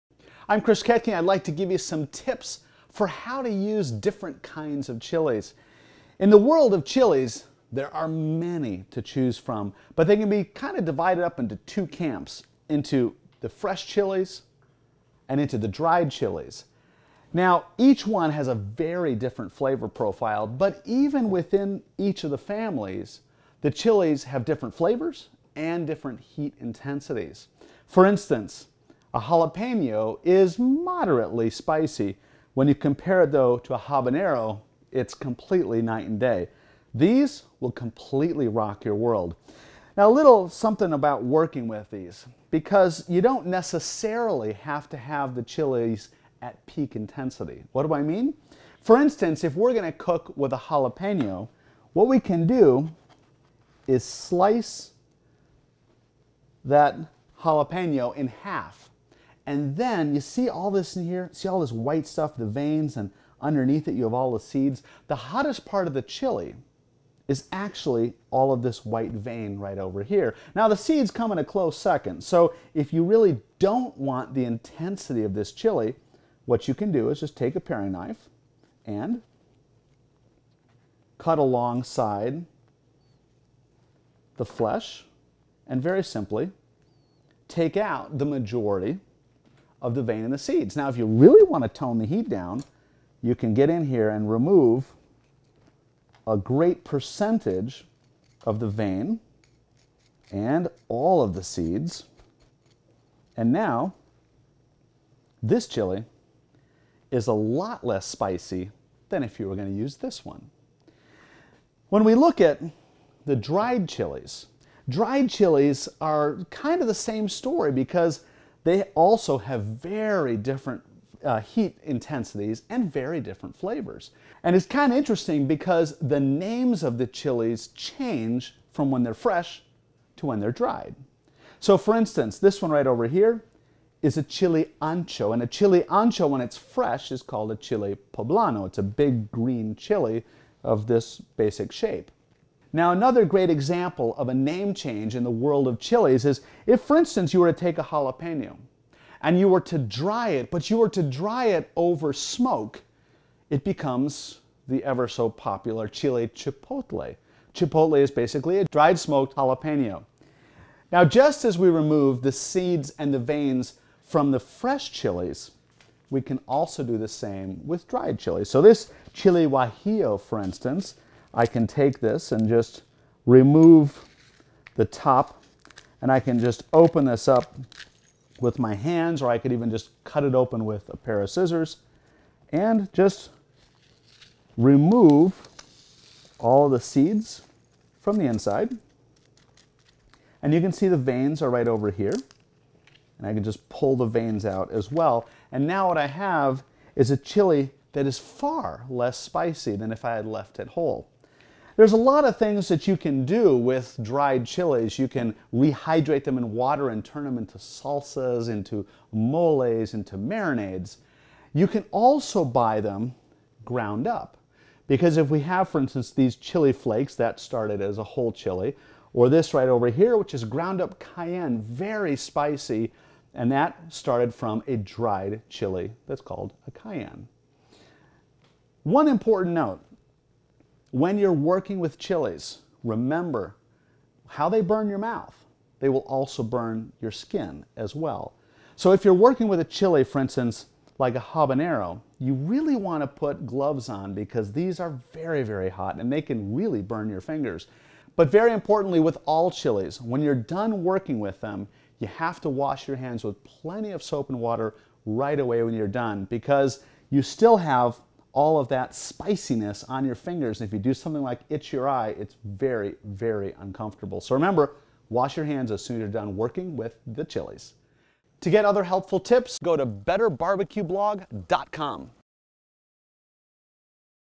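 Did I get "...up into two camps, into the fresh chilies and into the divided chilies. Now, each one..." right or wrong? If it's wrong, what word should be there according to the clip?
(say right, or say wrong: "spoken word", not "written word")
wrong: "dried", not "divided".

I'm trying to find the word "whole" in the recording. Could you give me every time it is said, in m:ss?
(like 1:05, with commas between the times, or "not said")
3:20, 3:38.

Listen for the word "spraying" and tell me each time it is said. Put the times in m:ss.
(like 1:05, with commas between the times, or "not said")
not said.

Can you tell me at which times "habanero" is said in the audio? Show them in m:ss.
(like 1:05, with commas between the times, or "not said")
0:33, 4:01.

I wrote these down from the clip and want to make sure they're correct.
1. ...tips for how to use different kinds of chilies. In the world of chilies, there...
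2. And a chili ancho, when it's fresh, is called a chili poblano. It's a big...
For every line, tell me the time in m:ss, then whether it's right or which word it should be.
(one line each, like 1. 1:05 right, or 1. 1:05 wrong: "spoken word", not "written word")
1. 0:02 right
2. 2:15 right.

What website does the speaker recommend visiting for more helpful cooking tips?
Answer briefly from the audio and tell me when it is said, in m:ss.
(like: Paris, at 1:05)
betterbarbecueblog.com, at 4:29.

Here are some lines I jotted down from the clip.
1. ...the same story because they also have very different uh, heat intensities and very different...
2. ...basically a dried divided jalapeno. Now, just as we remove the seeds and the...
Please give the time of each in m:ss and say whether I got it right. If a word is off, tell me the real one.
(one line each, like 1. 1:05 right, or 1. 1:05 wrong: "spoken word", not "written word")
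1. 1:56 right
2. 2:38 wrong: "smoked", not "divided".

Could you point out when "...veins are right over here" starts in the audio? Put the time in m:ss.
3:10.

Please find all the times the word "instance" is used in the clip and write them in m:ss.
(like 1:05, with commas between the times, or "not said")
0:28, 0:48, 2:11, 2:26, 2:50, 3:35, 4:00.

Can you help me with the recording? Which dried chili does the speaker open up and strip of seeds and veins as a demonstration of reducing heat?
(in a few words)
Guajillo.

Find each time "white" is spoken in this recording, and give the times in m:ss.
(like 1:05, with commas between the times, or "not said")
1:01, 1:08.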